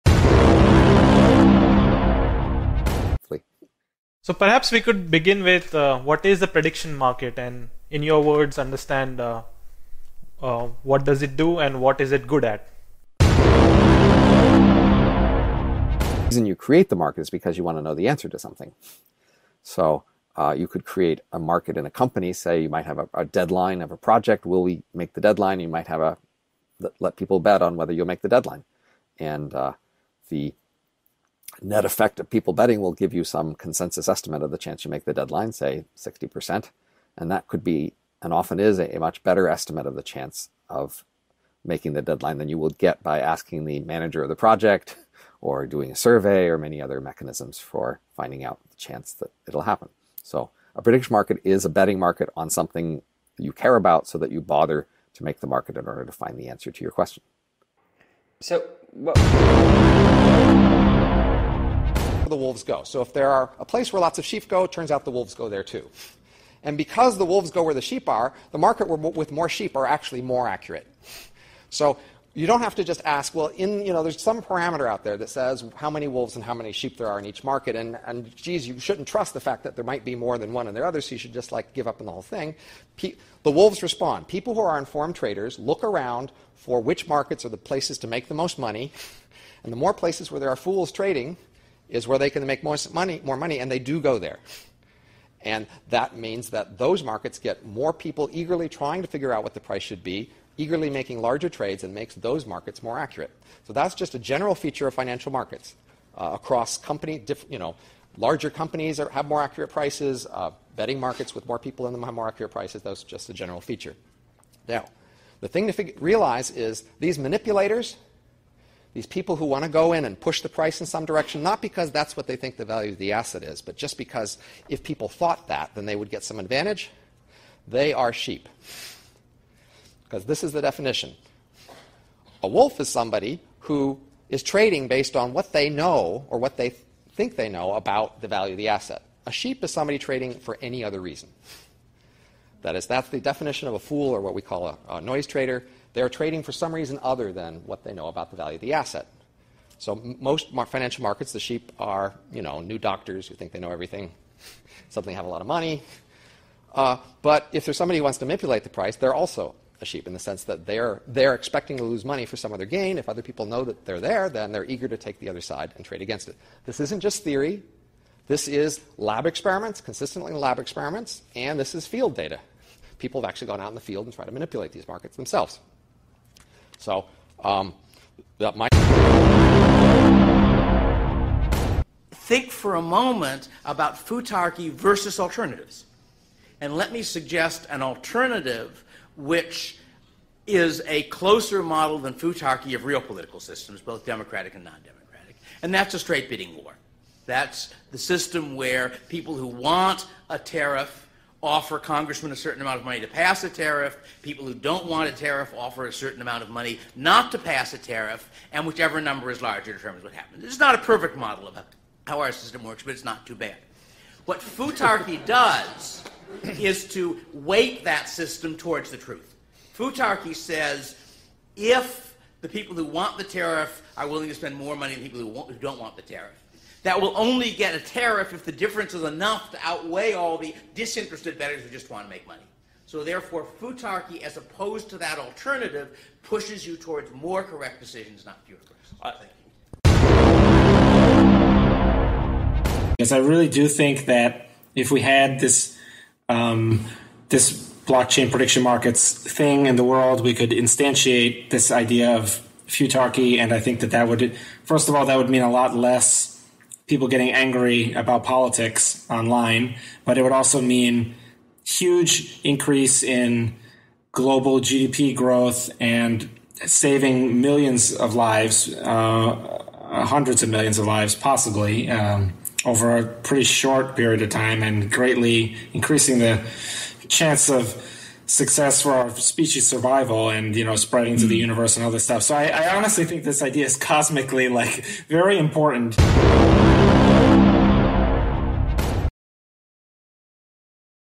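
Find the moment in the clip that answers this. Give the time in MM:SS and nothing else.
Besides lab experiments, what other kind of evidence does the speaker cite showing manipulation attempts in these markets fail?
02:51.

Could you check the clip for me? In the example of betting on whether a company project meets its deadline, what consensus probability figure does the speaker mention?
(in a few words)
60%.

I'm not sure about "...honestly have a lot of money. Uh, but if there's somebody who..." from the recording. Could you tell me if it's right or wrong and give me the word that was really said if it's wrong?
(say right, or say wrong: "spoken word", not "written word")
wrong: "suddenly", not "honestly".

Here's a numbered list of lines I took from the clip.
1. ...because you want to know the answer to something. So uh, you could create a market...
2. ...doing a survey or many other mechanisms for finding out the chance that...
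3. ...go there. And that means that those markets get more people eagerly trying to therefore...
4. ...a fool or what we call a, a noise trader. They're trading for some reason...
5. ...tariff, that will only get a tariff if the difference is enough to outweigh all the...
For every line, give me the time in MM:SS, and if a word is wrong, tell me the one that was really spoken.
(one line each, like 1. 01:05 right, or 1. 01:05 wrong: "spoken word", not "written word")
1. 00:17 right
2. 00:45 right
3. 01:34 wrong: "figure", not "therefore"
4. 02:23 right
5. 03:46 right.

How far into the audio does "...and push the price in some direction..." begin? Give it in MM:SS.
02:00.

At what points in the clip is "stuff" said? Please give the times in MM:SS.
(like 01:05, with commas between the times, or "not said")
04:42.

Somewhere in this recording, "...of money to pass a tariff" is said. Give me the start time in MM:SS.
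03:22.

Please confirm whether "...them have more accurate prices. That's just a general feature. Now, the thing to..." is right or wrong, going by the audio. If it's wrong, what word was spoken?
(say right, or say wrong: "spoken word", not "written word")
right.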